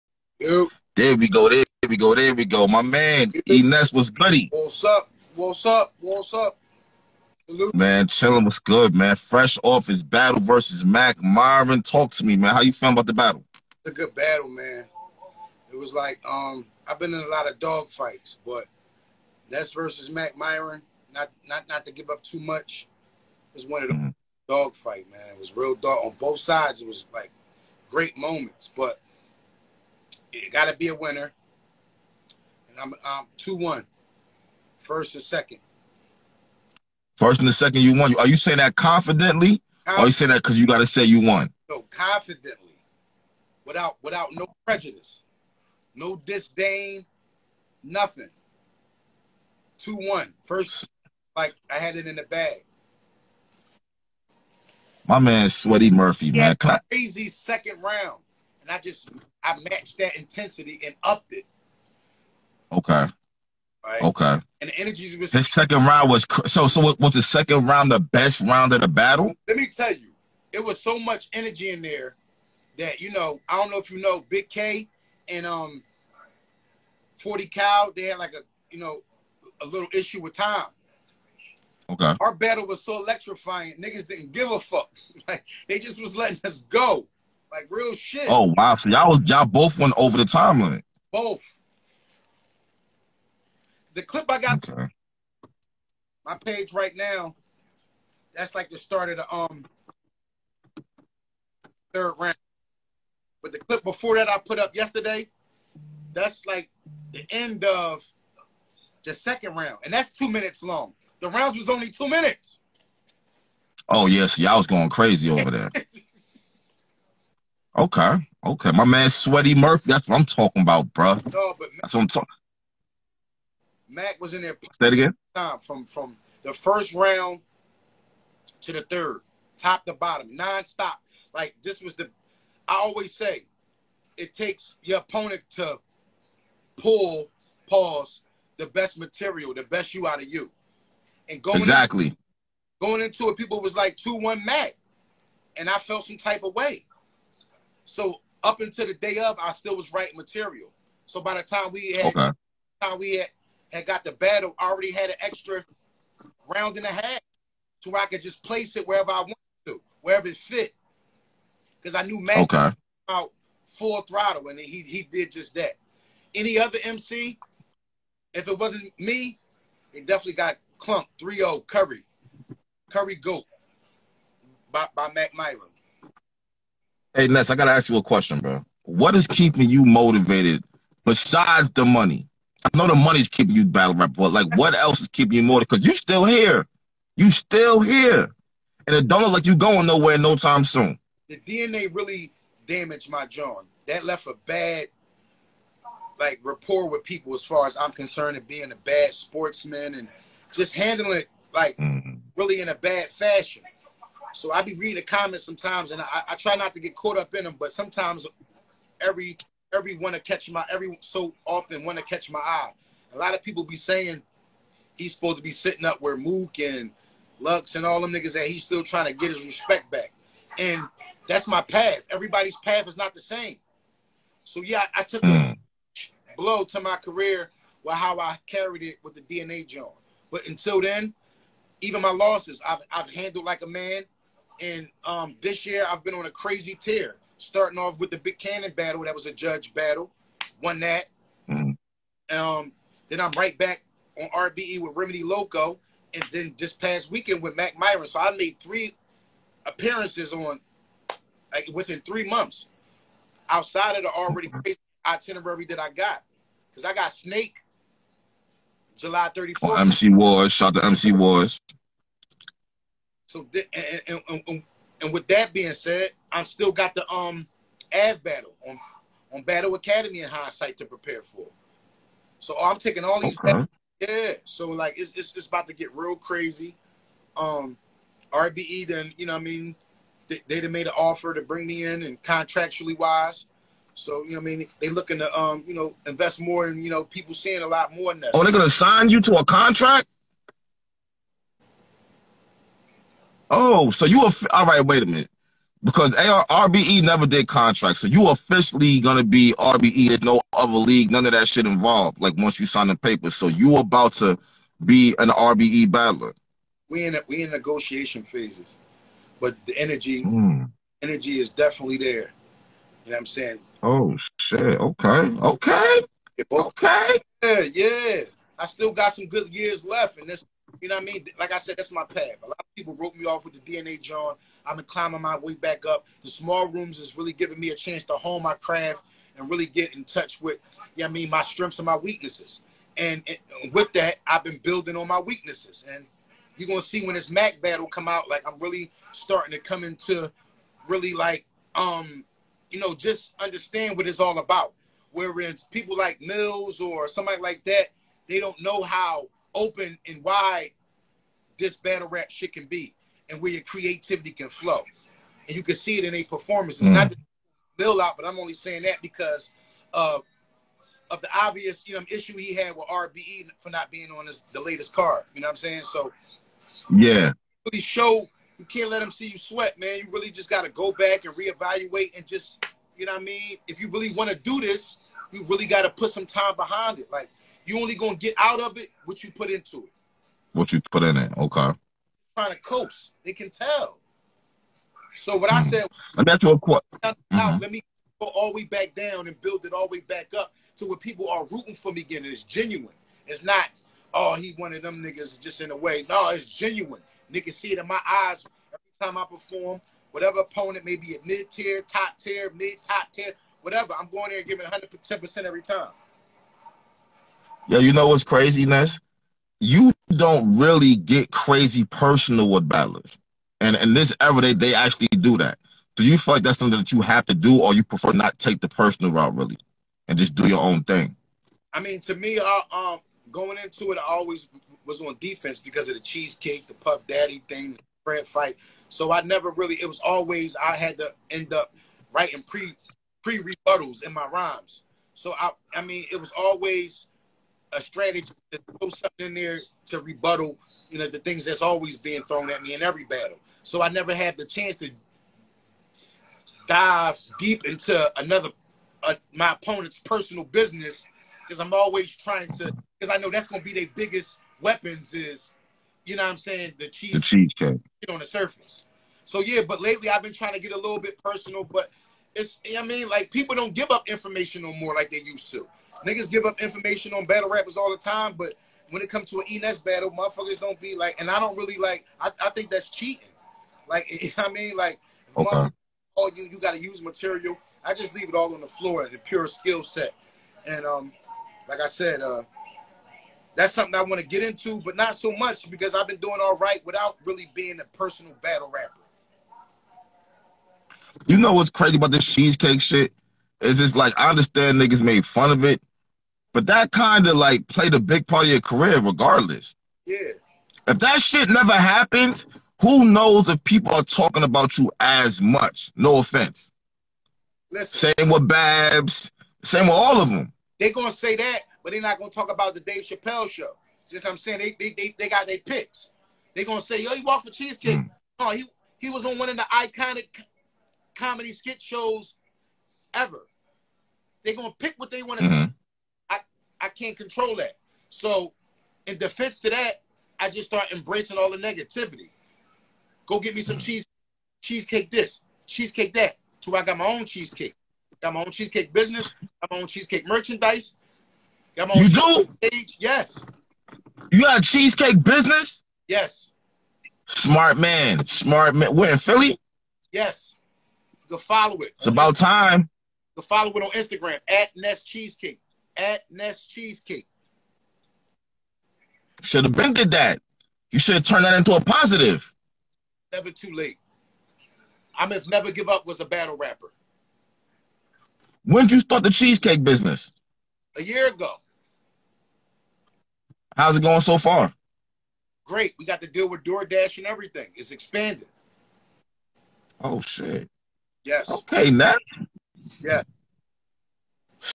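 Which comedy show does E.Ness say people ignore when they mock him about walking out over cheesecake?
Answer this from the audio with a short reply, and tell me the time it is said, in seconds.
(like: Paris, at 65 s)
Dave Chappelle show, at 512 s.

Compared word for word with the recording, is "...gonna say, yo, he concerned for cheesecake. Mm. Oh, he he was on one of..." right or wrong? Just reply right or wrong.
wrong.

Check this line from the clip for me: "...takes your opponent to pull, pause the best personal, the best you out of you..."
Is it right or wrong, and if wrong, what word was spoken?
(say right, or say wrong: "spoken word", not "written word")
wrong: "material", not "personal".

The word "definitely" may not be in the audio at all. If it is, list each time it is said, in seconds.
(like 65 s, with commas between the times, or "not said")
170 s, 311 s.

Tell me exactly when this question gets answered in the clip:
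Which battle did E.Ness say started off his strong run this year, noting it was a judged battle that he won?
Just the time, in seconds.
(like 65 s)
238 s.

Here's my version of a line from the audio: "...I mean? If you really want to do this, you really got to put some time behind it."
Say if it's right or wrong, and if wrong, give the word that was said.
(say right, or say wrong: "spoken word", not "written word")
right.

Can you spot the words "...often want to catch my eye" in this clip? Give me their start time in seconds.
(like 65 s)
211 s.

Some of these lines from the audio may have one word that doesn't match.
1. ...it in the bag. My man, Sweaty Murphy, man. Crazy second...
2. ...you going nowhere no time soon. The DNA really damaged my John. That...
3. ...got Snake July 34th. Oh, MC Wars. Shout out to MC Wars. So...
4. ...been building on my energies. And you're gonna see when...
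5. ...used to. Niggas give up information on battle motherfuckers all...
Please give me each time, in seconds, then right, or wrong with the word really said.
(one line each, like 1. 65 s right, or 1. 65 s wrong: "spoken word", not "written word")
1. 51 s right
2. 189 s right
3. 256 s right
4. 334 s wrong: "weaknesses", not "energies"
5. 465 s wrong: "rappers", not "motherfuckers".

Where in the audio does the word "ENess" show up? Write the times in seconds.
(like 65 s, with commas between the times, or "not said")
3 s, 469 s.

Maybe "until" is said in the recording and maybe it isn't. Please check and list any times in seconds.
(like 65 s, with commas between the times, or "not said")
148 s, 230 s.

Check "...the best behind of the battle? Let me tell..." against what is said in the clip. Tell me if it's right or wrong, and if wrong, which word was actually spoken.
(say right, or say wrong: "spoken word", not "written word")
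wrong: "round", not "behind".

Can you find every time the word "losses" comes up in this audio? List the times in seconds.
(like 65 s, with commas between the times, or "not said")
232 s.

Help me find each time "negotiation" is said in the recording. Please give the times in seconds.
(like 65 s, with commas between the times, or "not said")
307 s.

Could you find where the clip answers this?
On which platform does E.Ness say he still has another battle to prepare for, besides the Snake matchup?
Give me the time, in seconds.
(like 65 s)
269 s.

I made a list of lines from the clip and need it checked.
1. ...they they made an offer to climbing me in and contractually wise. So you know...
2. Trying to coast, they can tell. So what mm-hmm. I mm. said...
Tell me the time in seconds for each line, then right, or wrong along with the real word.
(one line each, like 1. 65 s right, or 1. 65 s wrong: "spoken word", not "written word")
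1. 280 s wrong: "bring", not "climbing"
2. 382 s right.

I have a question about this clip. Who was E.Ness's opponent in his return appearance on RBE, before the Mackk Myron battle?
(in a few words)
Remedy Loco.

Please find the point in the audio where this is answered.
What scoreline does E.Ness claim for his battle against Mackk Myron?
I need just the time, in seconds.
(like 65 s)
33 s.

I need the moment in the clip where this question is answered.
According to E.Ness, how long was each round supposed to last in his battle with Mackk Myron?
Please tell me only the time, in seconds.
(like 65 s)
111 s.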